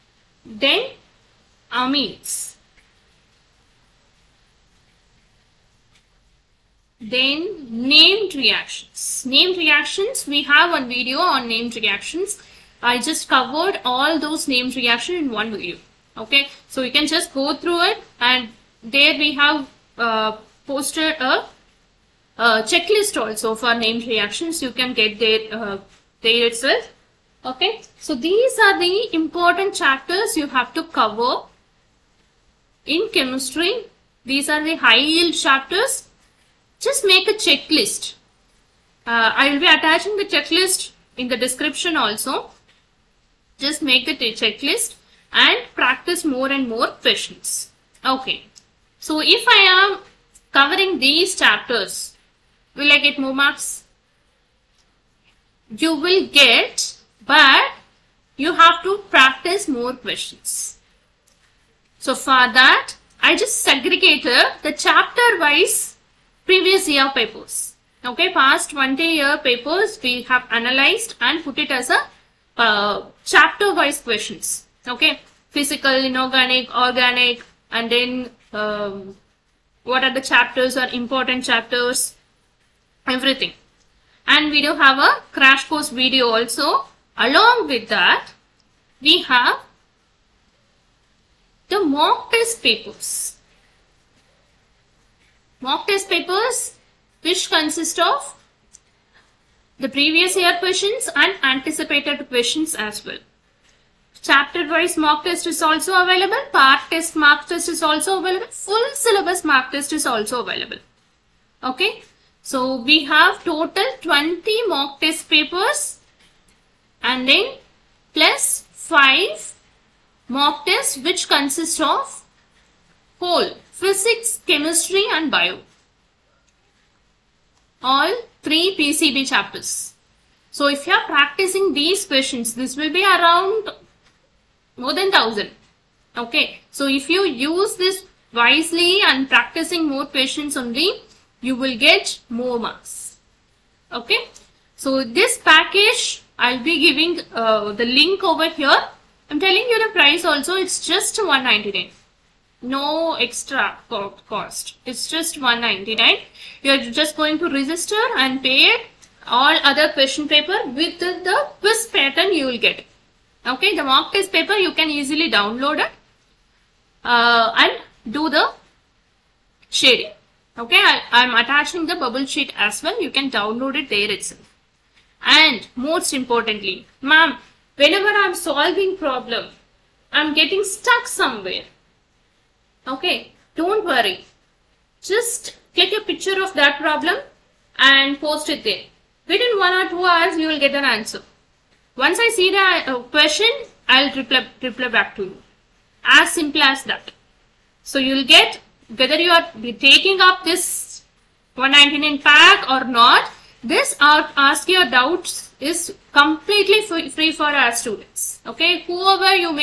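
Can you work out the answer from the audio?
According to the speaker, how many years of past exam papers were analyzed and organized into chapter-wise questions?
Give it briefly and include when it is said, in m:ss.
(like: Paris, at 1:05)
20, at 1:08.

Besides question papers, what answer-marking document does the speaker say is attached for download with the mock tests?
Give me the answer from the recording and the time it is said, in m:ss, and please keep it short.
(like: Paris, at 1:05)
bubble sheet, at 2:51.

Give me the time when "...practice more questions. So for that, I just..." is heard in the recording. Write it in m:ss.
0:59.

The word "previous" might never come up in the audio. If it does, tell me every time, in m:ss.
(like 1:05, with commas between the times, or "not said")
1:06, 1:39.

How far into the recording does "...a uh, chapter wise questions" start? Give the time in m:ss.
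1:11.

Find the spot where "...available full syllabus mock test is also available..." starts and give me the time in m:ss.
1:48.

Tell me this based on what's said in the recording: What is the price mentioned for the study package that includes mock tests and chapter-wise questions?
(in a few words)
199.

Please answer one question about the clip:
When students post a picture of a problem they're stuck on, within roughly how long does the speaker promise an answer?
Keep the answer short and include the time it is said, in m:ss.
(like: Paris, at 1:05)
one or two hours, at 3:09.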